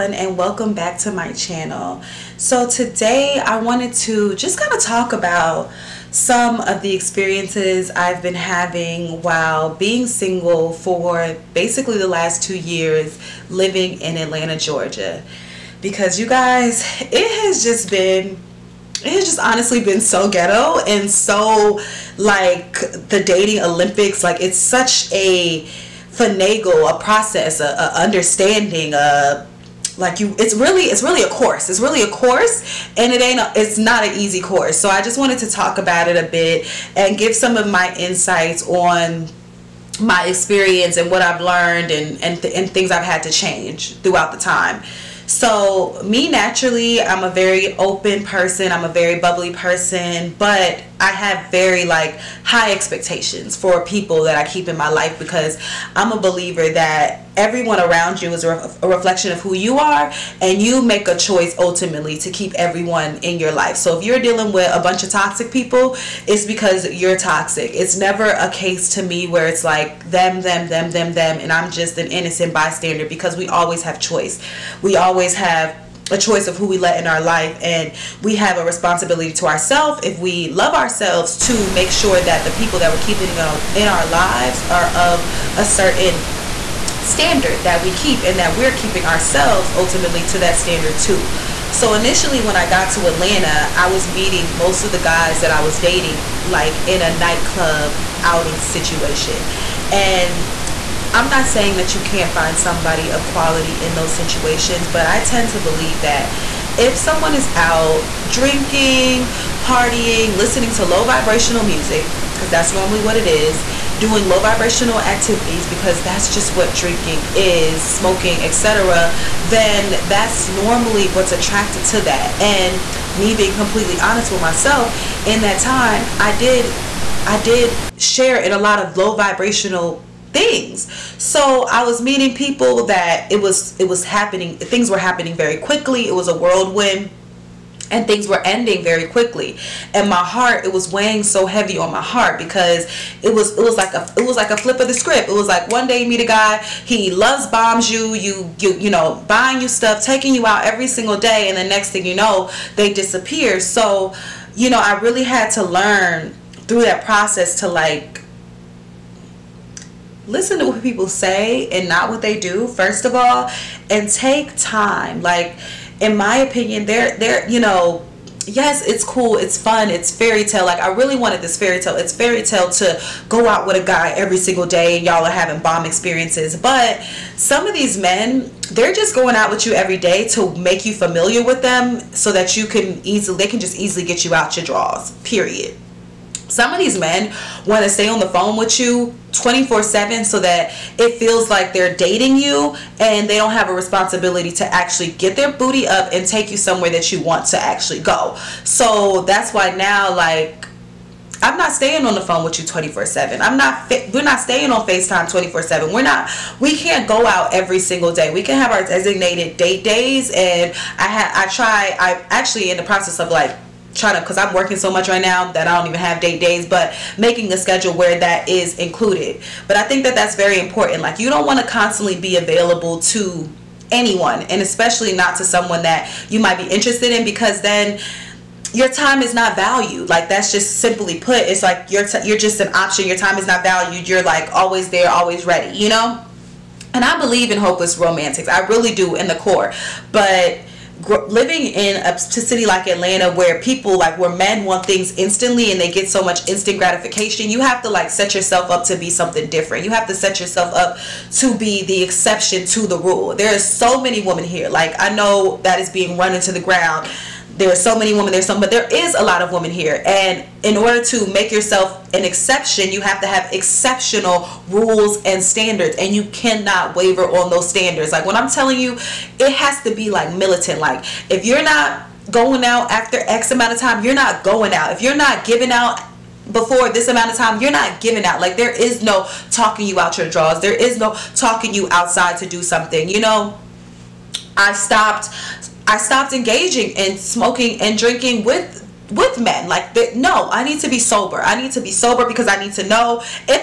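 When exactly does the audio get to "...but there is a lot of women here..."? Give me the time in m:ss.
4:18.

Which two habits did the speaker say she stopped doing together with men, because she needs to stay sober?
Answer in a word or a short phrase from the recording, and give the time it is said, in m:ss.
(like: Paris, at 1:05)
Smoking and drinking, at 4:47.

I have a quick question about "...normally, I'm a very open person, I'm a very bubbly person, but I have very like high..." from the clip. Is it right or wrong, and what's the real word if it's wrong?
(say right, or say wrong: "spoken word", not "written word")
wrong: "naturally", not "normally".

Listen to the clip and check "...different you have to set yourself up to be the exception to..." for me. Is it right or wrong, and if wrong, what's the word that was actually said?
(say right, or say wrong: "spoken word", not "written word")
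right.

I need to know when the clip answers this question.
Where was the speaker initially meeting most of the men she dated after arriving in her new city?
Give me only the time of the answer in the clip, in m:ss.
1:37.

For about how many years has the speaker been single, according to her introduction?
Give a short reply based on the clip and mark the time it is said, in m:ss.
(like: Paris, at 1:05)
2, at 0:12.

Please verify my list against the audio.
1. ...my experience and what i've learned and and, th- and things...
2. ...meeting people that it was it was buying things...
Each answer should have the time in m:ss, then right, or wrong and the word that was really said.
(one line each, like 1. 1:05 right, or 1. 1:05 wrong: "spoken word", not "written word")
1. 0:40 right
2. 2:12 wrong: "happening", not "buying".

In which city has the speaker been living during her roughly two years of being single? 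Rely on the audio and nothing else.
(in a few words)
Atlanta, Georgia.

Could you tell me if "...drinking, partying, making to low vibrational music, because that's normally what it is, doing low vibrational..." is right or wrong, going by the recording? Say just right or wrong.
wrong.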